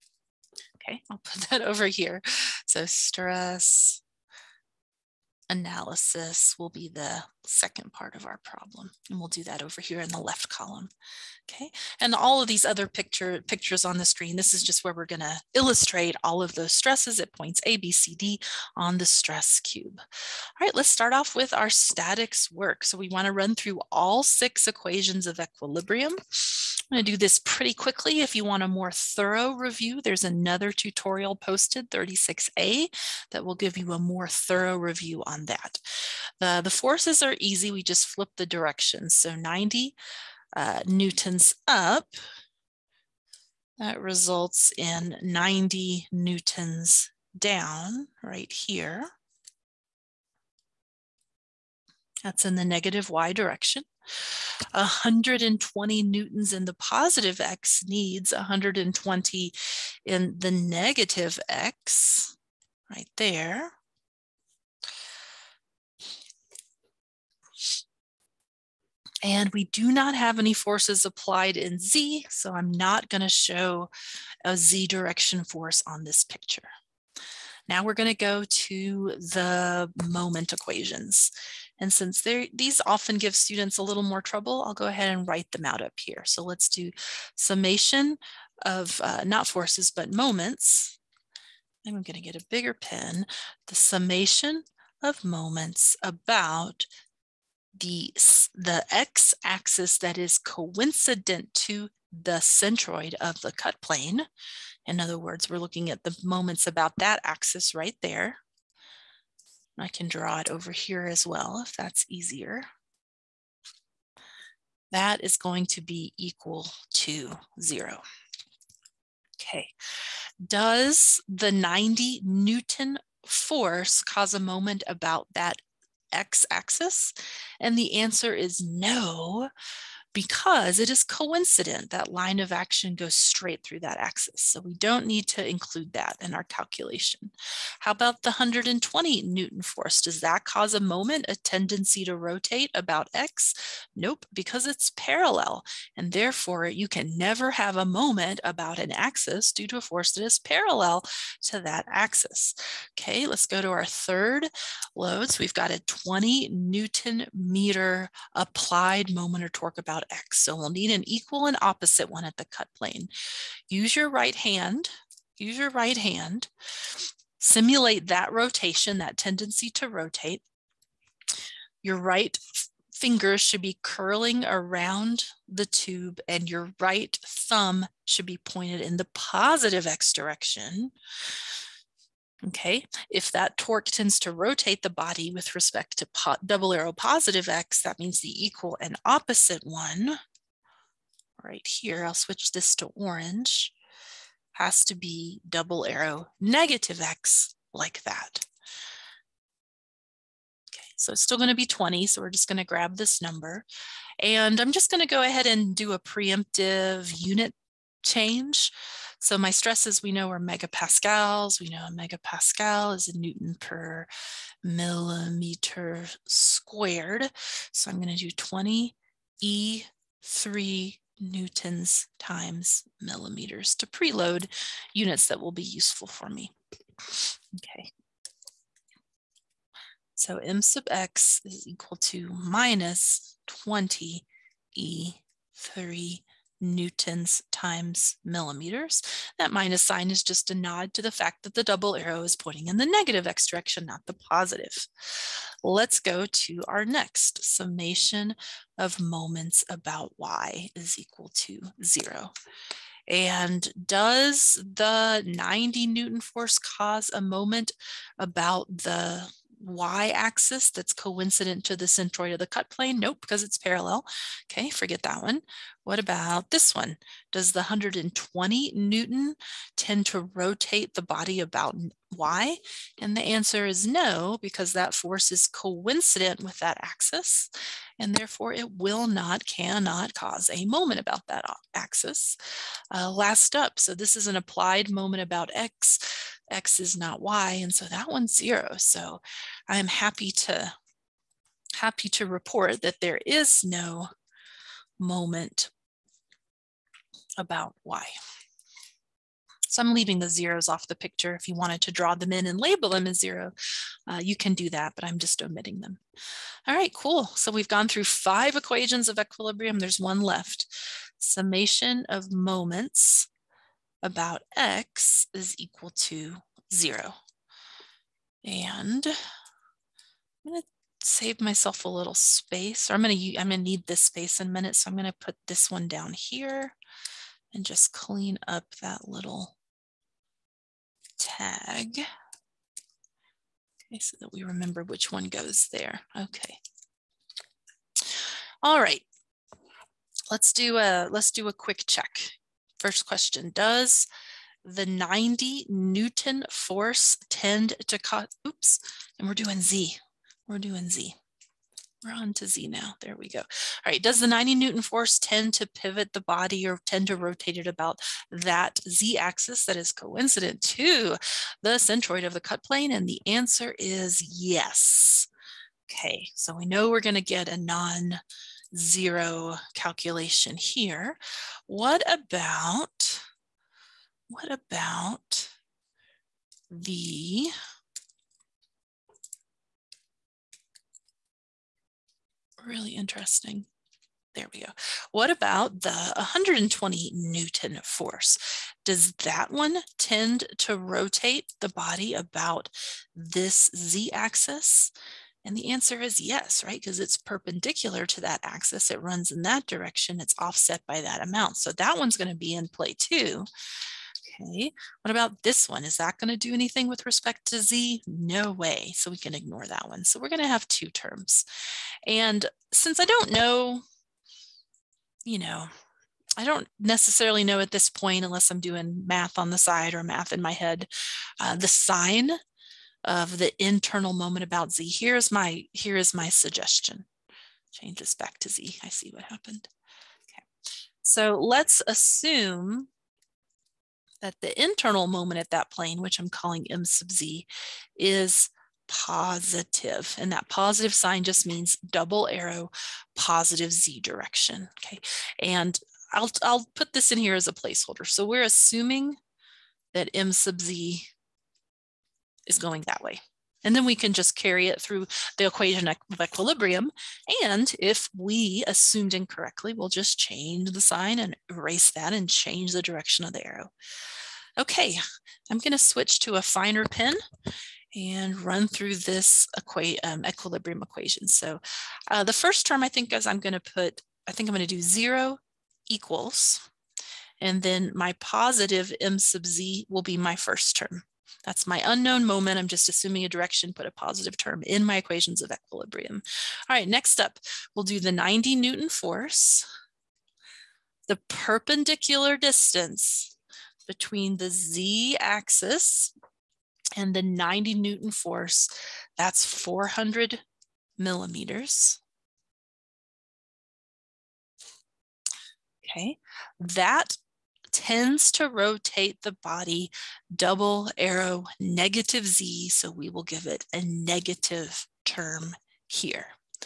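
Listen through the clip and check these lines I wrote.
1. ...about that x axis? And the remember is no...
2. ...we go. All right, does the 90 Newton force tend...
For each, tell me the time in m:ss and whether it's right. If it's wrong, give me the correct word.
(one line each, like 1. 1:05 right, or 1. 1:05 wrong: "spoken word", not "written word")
1. 2:04 wrong: "answer", not "remember"
2. 5:53 right.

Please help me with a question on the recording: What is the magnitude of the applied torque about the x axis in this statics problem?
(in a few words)
20 Newton meters.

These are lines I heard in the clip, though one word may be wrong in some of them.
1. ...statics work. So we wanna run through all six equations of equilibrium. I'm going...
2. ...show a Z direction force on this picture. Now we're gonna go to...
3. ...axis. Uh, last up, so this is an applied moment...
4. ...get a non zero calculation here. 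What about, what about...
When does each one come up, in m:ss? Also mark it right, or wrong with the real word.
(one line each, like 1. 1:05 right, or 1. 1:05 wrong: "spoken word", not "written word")
1. 0:21 right
2. 1:13 right
3. 4:41 right
4. 6:07 right.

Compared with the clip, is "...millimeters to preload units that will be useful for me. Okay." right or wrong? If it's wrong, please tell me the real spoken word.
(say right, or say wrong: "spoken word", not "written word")
right.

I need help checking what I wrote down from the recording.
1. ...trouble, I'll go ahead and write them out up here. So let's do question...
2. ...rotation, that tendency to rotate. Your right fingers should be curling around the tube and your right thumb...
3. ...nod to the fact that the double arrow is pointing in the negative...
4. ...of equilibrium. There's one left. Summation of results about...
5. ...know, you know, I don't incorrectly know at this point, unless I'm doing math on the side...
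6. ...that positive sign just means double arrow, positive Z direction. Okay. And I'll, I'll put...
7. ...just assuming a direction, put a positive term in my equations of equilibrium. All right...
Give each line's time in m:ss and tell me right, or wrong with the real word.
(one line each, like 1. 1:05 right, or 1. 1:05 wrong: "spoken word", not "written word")
1. 1:24 wrong: "summation", not "question"
2. 2:48 right
3. 4:00 right
4. 5:09 wrong: "moments", not "results"
5. 6:53 wrong: "necessarily", not "incorrectly"
6. 7:20 right
7. 8:02 right.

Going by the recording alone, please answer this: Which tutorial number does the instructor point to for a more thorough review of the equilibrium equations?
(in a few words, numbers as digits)
36A.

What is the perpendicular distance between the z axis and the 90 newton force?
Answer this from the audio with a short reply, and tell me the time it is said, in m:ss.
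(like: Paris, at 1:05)
400 millimeters, at 8:19.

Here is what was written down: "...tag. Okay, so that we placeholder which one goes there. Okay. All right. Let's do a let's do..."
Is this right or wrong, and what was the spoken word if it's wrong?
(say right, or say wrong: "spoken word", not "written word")
wrong: "remember", not "placeholder".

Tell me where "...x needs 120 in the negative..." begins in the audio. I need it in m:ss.
0:57.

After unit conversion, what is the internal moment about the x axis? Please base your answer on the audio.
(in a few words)
minus 20E3 newton-millimeters.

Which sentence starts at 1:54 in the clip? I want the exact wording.
That is going to be equal to zero.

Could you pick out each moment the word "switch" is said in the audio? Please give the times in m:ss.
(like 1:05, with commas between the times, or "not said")
3:12, 7:45.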